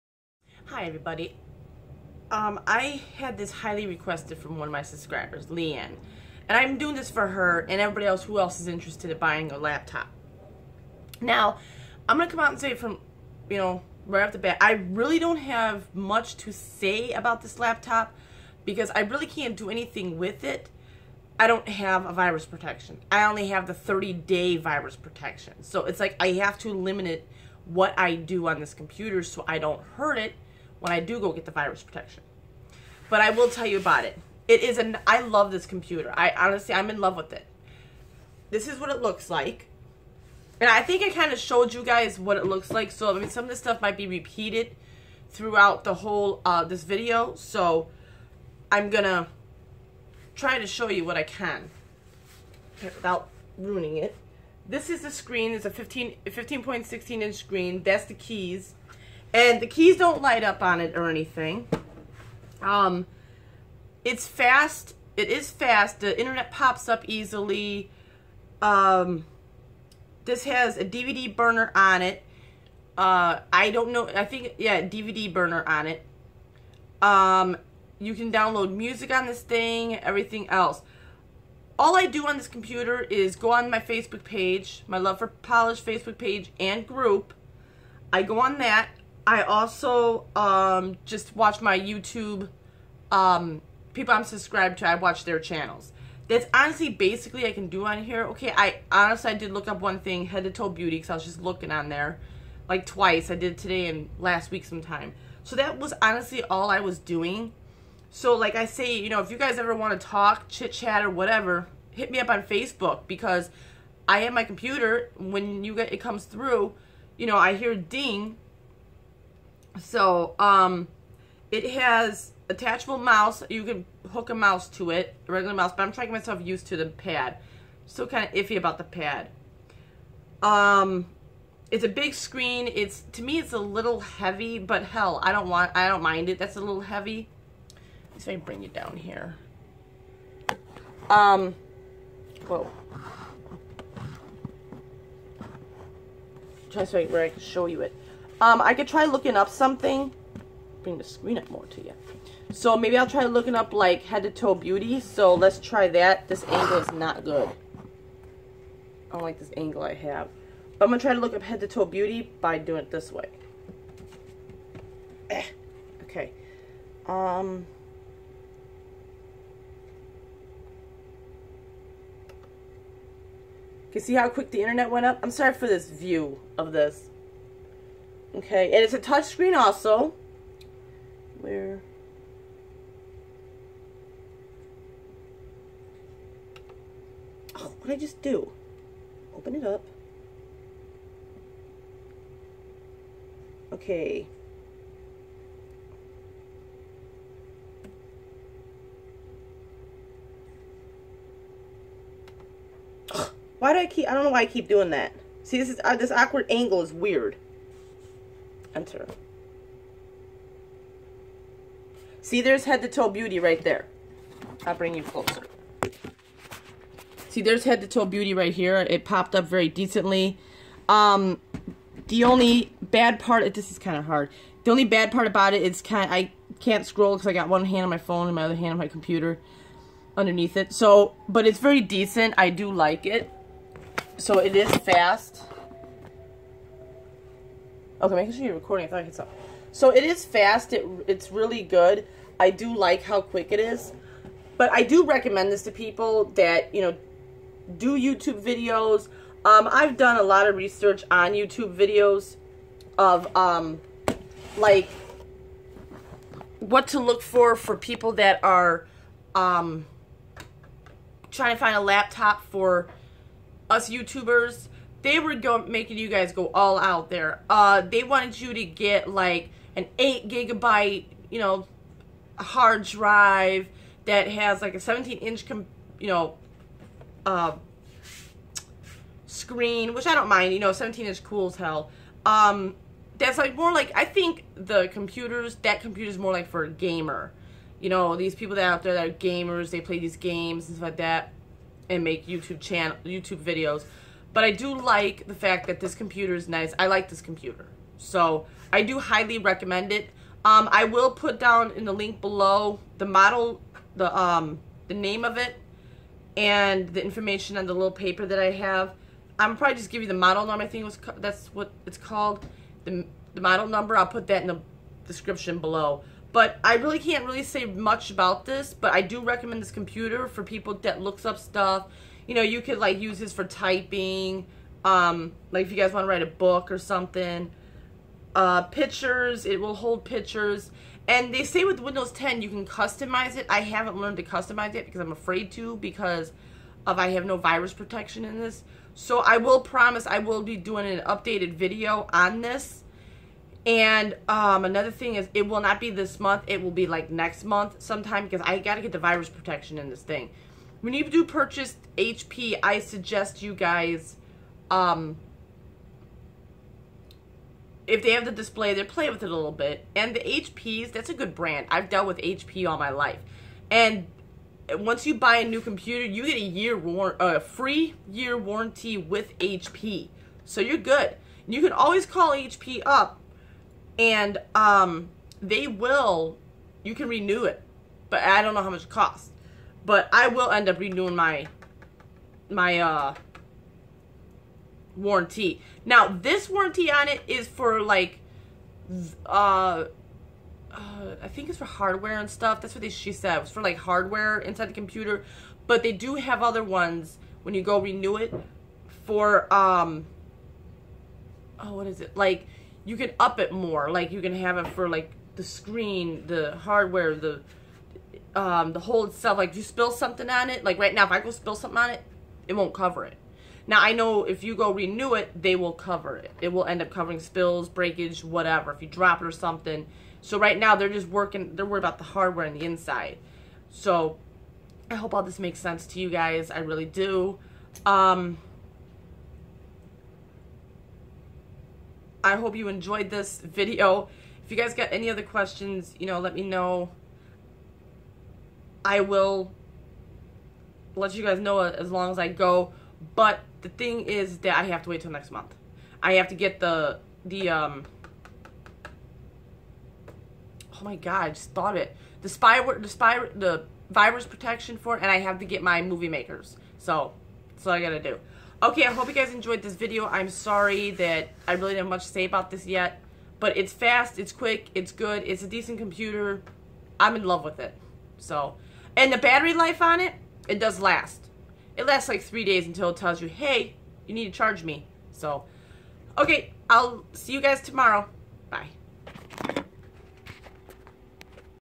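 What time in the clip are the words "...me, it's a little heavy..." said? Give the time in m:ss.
2:13.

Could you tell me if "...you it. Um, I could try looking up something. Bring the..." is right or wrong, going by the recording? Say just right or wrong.
right.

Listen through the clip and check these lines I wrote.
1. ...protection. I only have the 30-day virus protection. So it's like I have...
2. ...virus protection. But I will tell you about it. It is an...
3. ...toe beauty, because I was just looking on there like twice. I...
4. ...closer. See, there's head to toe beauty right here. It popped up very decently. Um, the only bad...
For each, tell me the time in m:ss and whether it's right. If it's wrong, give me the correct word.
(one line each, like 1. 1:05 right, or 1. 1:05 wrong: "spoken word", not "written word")
1. 0:22 right
2. 0:31 right
3. 1:40 right
4. 3:35 right.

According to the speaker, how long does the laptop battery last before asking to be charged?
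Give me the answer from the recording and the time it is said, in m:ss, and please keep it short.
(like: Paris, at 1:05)
3 days, at 7:52.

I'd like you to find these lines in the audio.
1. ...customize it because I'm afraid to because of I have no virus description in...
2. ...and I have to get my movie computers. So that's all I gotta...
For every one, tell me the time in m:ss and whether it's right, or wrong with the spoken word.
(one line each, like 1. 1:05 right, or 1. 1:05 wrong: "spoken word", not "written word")
1. 5:34 wrong: "protection", not "description"
2. 7:35 wrong: "makers", not "computers".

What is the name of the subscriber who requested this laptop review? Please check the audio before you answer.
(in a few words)
Leanne.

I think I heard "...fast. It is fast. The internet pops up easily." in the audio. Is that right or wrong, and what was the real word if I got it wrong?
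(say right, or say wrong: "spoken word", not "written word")
right.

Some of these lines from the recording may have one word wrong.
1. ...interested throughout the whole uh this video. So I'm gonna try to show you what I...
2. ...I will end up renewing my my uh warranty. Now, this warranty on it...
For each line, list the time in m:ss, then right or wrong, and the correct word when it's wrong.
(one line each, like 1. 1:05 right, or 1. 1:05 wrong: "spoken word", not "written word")
1. 0:44 wrong: "repeated", not "interested"
2. 6:20 right.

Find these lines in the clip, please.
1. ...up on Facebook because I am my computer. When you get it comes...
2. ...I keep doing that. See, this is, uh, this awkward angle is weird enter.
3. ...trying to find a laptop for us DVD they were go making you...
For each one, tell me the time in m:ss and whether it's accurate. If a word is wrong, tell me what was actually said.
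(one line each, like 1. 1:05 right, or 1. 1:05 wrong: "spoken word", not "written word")
1. 1:52 right
2. 3:24 right
3. 4:21 wrong: "YouTubers", not "DVD".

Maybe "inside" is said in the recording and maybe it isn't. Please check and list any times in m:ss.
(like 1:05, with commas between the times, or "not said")
6:34, 7:02.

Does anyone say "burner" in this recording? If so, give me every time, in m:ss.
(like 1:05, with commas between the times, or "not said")
1:11, 1:15.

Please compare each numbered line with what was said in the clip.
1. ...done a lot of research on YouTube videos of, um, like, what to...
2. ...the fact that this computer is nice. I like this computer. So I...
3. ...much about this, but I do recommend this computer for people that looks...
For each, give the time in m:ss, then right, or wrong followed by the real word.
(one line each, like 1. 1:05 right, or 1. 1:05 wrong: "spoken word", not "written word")
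1. 4:09 right
2. 4:55 right
3. 5:17 right.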